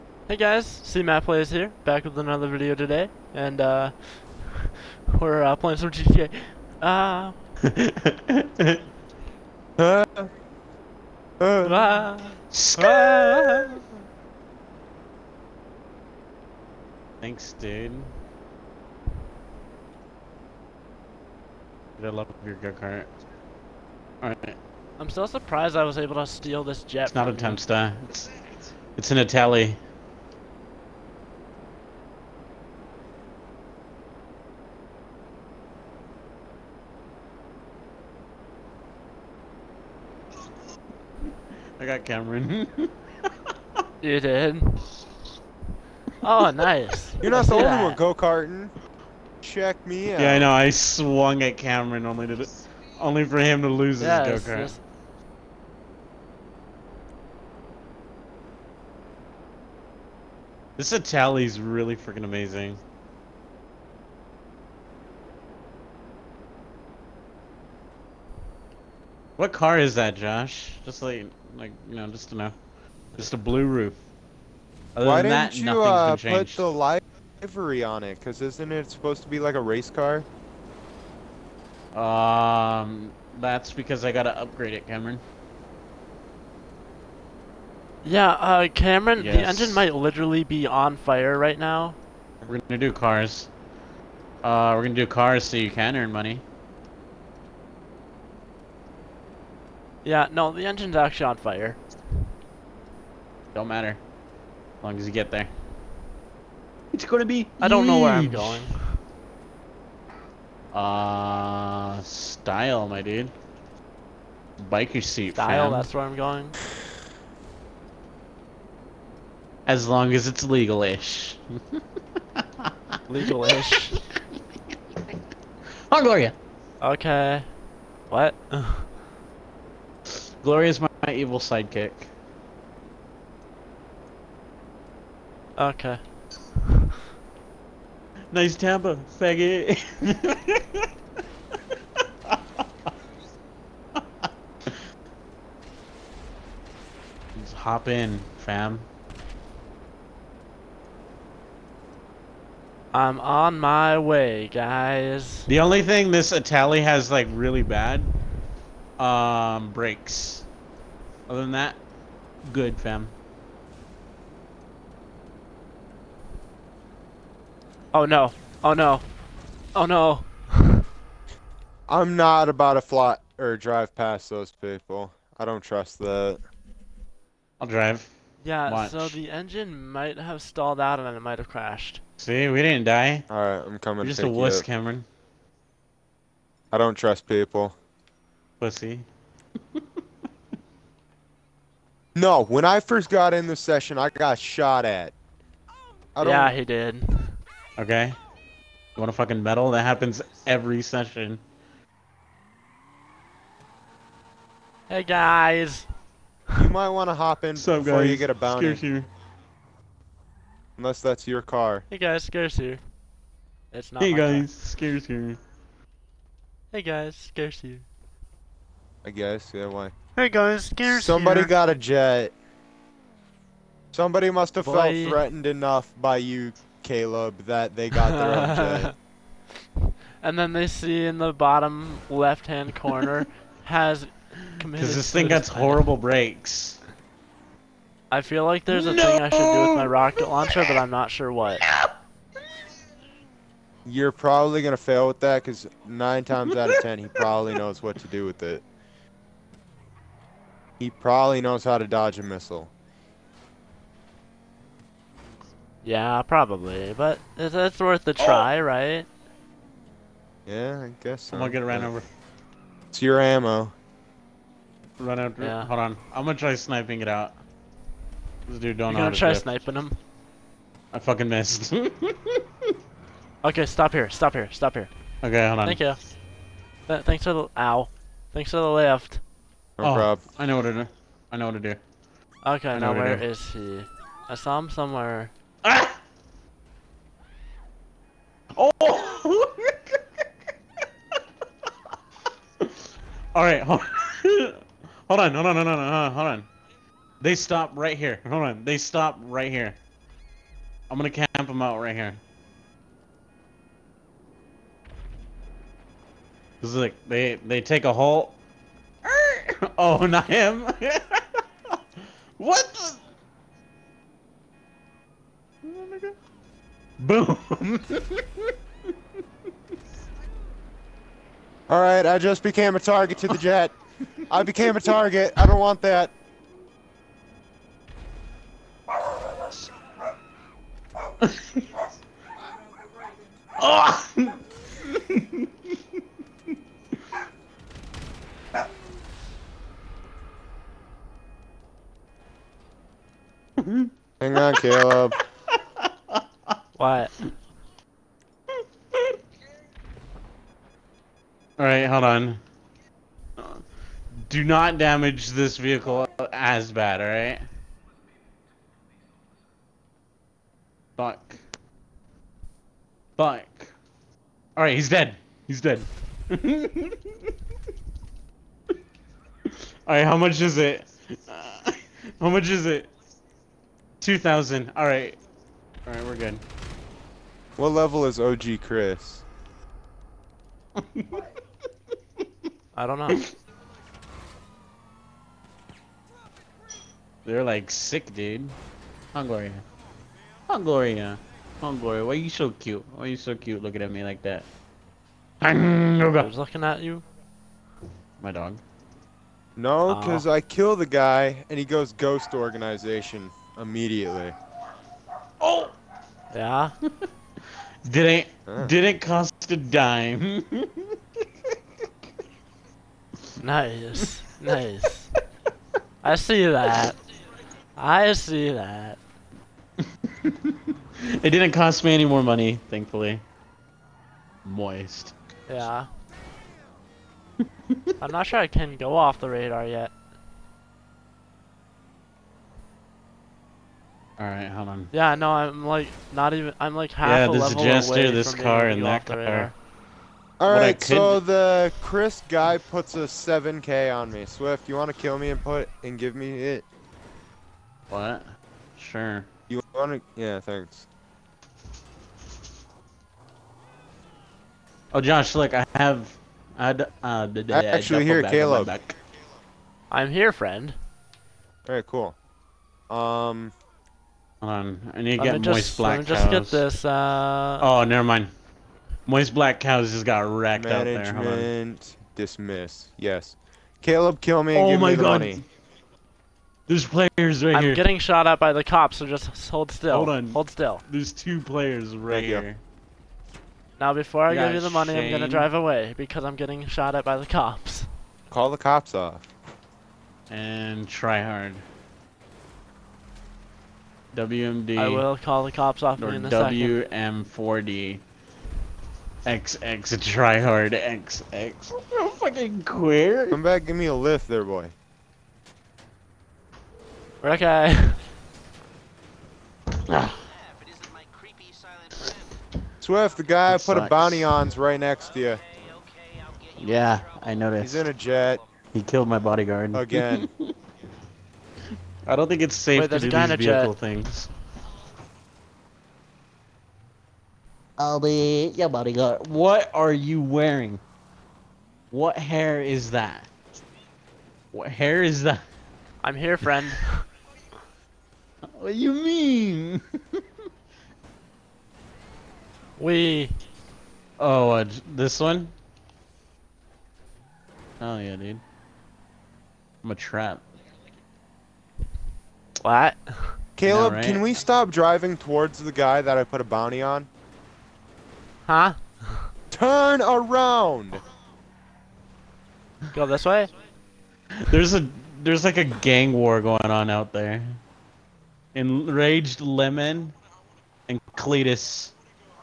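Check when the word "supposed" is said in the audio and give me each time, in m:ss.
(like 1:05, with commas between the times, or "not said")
1:18.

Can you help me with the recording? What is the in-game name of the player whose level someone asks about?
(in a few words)
OG Chris.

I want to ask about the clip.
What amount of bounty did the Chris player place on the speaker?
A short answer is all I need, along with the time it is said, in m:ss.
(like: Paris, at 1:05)
7k, at 7:23.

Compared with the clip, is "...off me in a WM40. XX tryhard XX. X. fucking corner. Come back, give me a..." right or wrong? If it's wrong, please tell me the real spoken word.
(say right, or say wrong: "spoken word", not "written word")
wrong: "queer", not "corner".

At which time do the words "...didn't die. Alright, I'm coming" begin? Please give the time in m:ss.
3:02.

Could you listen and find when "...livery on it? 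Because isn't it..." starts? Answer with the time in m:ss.
1:17.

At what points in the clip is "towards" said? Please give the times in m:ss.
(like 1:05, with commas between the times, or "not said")
9:15.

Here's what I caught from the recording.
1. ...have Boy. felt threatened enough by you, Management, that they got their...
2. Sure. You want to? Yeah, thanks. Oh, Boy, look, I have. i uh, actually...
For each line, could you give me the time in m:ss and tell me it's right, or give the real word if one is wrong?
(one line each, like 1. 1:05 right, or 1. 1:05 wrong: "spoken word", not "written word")
1. 3:44 wrong: "Caleb", not "Management"
2. 7:28 wrong: "Josh", not "Boy".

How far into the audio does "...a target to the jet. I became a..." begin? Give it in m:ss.
5:22.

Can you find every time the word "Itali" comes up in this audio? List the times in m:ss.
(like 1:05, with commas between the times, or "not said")
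0:29, 1:00, 2:36.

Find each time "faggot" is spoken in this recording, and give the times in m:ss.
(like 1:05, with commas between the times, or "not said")
2:19.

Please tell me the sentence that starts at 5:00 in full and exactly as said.
I'm gonna camp them out right here.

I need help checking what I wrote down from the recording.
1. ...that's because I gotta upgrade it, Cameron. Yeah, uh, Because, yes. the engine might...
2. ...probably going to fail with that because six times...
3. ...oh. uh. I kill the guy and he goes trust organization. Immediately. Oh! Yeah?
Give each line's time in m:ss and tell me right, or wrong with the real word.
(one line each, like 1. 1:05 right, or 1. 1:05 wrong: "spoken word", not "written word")
1. 1:23 wrong: "Cameron", not "Because"
2. 4:04 wrong: "nine", not "six"
3. 6:40 wrong: "ghost", not "trust".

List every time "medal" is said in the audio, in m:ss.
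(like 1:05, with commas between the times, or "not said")
3:19.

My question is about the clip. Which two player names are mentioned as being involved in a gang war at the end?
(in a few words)
Enraged Lemon and Cletus.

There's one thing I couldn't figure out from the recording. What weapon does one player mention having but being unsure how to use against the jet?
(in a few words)
Rocket launcher.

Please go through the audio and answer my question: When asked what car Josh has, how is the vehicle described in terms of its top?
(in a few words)
A blue roof.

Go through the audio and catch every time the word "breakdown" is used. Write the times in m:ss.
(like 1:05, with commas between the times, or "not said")
not said.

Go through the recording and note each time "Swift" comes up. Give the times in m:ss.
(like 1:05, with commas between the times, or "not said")
7:24, 8:32.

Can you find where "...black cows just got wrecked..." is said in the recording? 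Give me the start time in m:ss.
7:49.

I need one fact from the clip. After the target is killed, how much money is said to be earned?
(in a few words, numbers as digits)
2,000.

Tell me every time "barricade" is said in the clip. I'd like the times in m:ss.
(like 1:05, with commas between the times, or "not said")
not said.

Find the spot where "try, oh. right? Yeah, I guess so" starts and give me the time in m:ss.
4:18.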